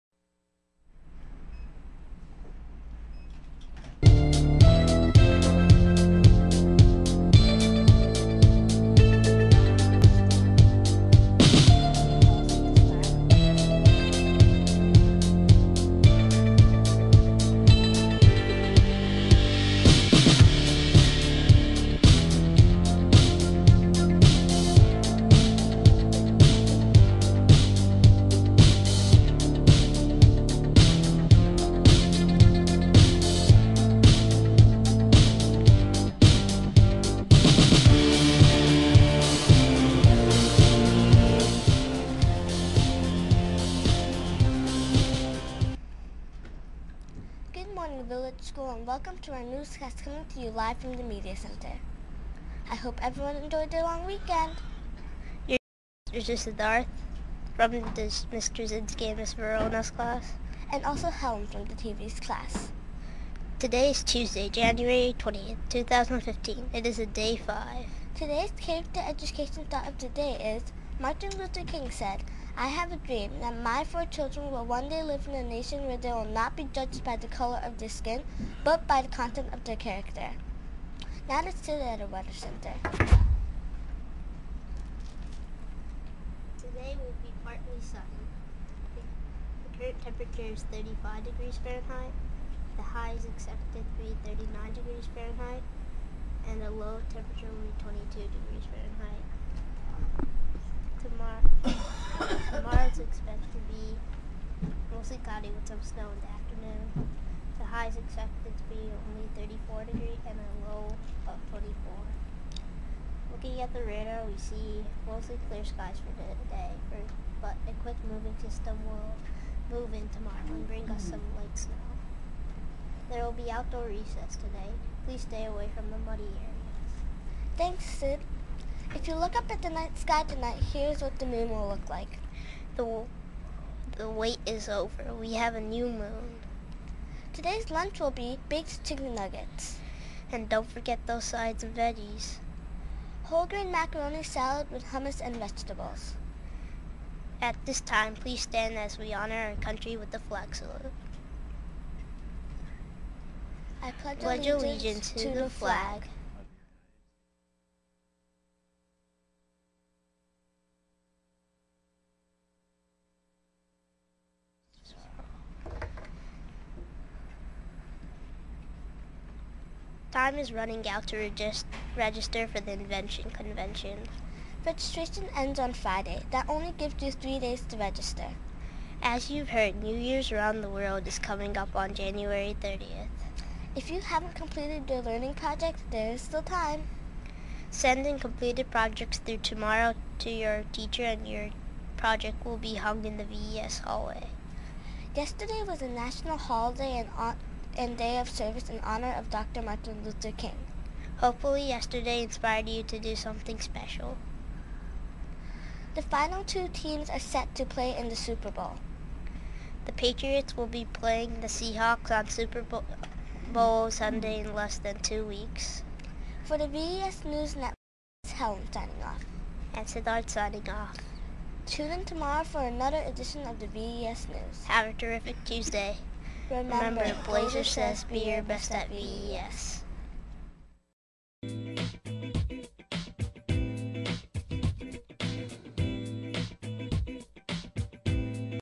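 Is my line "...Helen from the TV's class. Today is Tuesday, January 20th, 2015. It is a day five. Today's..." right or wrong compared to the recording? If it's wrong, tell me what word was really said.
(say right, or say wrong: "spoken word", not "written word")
right.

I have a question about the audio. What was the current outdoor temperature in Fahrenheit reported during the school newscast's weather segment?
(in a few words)
35 degrees.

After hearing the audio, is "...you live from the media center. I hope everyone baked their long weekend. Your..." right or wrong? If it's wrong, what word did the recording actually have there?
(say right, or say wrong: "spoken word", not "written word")
wrong: "enjoyed", not "baked".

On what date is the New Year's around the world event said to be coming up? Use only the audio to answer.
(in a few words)
January 30th.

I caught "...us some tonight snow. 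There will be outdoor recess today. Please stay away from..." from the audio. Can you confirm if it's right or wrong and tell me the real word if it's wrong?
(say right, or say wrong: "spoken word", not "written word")
wrong: "light", not "tonight".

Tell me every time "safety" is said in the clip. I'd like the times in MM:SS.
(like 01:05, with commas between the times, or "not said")
not said.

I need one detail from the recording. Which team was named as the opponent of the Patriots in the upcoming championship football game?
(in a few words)
Seahawks.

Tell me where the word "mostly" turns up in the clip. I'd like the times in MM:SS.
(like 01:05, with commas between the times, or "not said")
01:44, 01:55.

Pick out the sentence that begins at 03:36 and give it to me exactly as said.
For the VES News Network, it's Helen signing off.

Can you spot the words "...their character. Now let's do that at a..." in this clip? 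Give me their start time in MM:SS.
01:19.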